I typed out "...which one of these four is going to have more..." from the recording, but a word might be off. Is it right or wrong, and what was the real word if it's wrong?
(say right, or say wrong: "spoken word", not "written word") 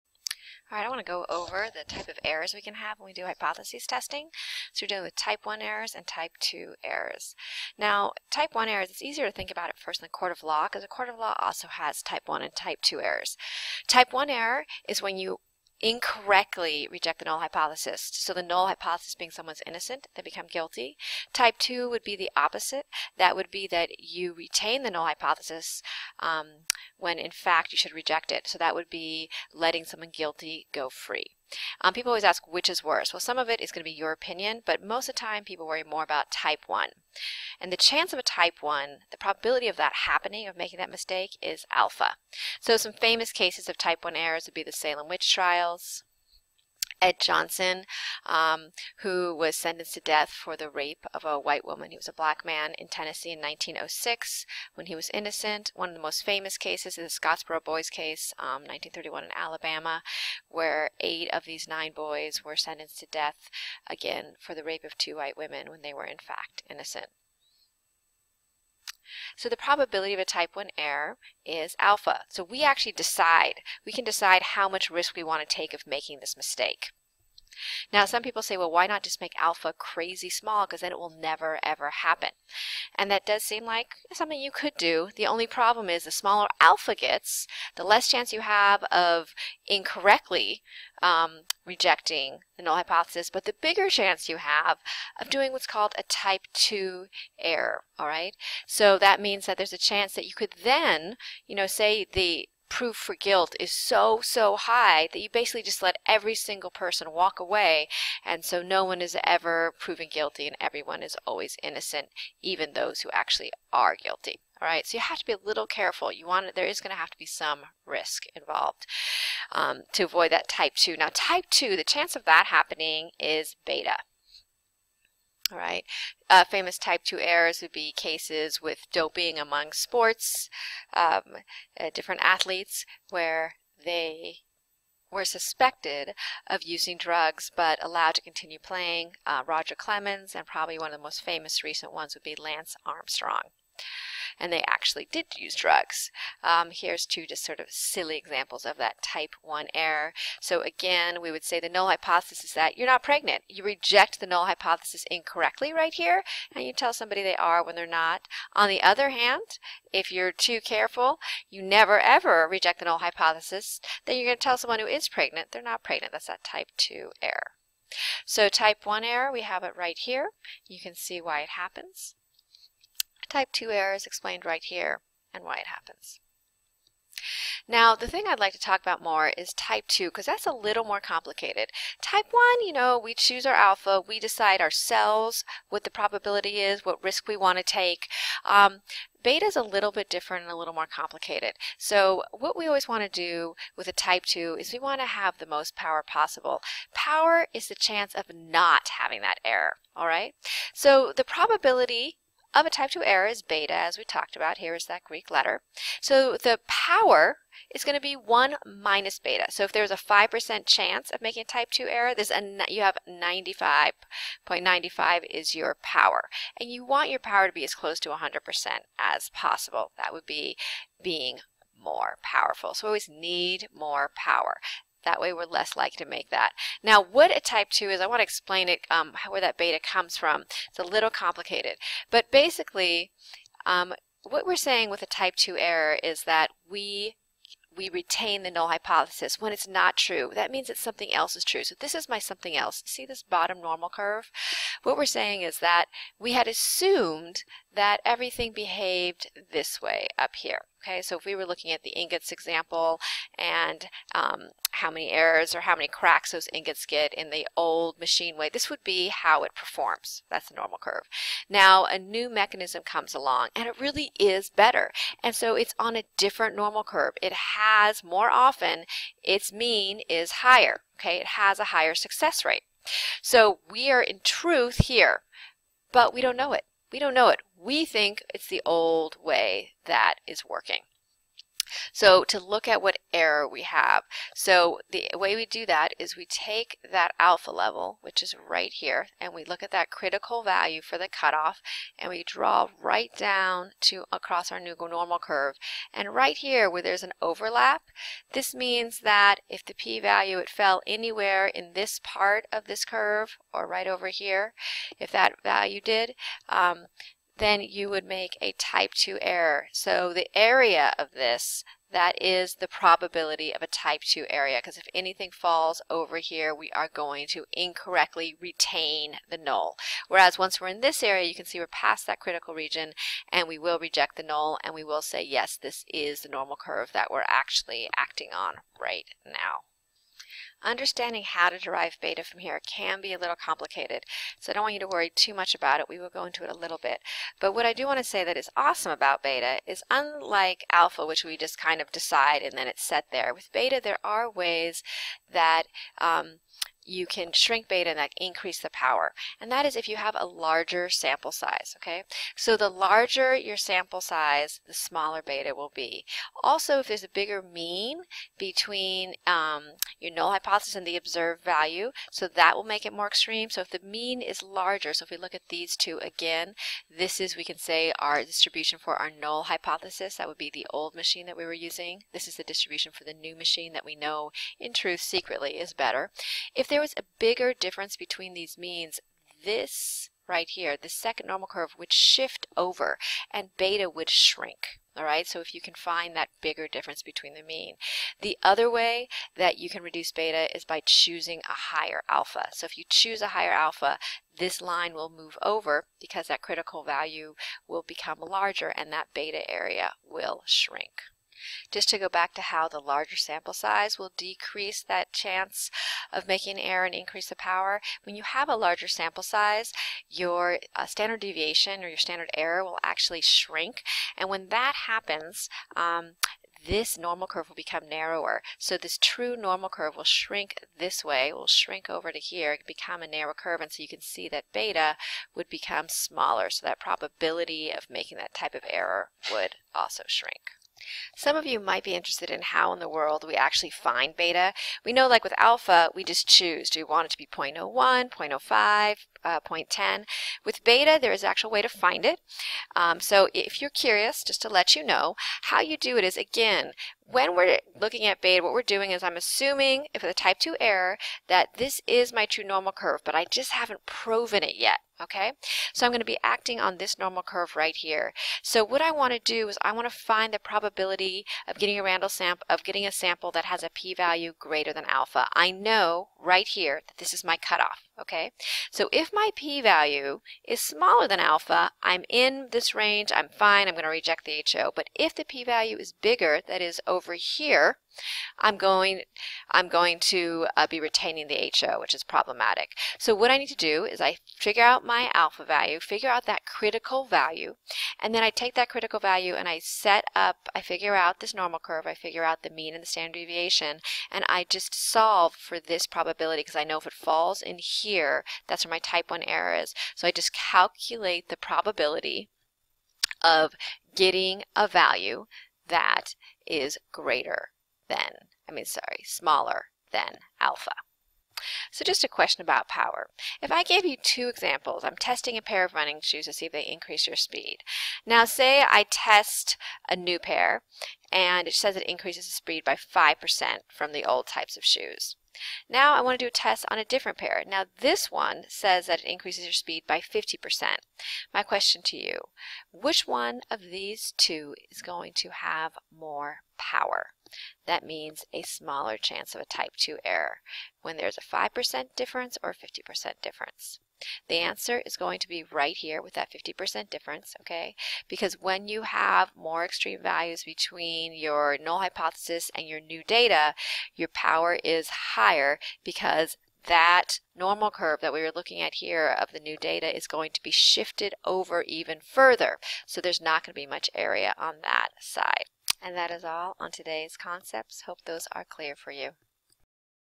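wrong: "two", not "four".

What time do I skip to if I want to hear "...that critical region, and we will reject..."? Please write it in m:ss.
5:22.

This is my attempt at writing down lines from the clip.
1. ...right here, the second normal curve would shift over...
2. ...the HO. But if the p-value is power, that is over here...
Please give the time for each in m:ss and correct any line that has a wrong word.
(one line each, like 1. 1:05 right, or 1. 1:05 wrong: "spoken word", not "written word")
1. 6:20 right
2. 7:54 wrong: "bigger", not "power".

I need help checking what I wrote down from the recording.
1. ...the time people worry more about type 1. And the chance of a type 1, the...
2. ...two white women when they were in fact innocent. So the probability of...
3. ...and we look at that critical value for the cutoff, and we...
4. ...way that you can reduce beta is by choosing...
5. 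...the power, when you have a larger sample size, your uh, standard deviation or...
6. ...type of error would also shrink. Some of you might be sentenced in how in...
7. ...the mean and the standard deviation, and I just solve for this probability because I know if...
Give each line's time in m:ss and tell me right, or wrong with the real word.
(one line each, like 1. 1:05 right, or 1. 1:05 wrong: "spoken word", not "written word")
1. 0:35 right
2. 1:04 right
3. 4:49 right
4. 6:28 right
5. 6:47 right
6. 7:08 wrong: "interested", not "sentenced"
7. 8:12 right.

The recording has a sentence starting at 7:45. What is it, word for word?
I know right here that this is my cutoff, okay?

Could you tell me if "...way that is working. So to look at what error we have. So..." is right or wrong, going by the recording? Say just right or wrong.
right.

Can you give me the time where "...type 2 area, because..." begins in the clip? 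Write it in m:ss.
5:13.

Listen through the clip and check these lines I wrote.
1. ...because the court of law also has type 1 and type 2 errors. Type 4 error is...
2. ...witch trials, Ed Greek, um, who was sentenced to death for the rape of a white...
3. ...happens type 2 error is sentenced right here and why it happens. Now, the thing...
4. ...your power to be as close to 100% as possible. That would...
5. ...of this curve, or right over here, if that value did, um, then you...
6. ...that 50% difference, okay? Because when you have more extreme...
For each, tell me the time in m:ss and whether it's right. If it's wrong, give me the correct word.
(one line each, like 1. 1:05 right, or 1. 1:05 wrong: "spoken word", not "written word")
1. 0:10 wrong: "1", not "4"
2. 0:45 wrong: "Johnson", not "Greek"
3. 2:51 wrong: "explained", not "sentenced"
4. 3:37 right
5. 5:02 right
6. 9:06 right.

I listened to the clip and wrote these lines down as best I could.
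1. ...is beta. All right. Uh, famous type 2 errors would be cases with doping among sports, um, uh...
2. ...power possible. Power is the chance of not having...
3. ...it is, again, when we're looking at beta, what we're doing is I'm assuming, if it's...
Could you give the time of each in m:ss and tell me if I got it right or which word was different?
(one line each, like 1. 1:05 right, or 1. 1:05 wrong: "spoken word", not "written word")
1. 2:03 right
2. 3:15 right
3. 7:25 right.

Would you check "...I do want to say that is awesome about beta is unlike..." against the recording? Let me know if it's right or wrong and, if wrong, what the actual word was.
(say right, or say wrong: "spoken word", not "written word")
right.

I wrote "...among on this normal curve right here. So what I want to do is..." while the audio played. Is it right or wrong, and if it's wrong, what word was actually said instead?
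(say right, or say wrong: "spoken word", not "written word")
wrong: "acting", not "among".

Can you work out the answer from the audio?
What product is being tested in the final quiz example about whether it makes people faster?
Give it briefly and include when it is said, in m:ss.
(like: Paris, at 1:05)
Running shoes, at 8:35.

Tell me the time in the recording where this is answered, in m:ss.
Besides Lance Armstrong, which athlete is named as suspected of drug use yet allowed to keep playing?
2:19.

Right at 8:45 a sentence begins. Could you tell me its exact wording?
Now I want to do a test on a different pair.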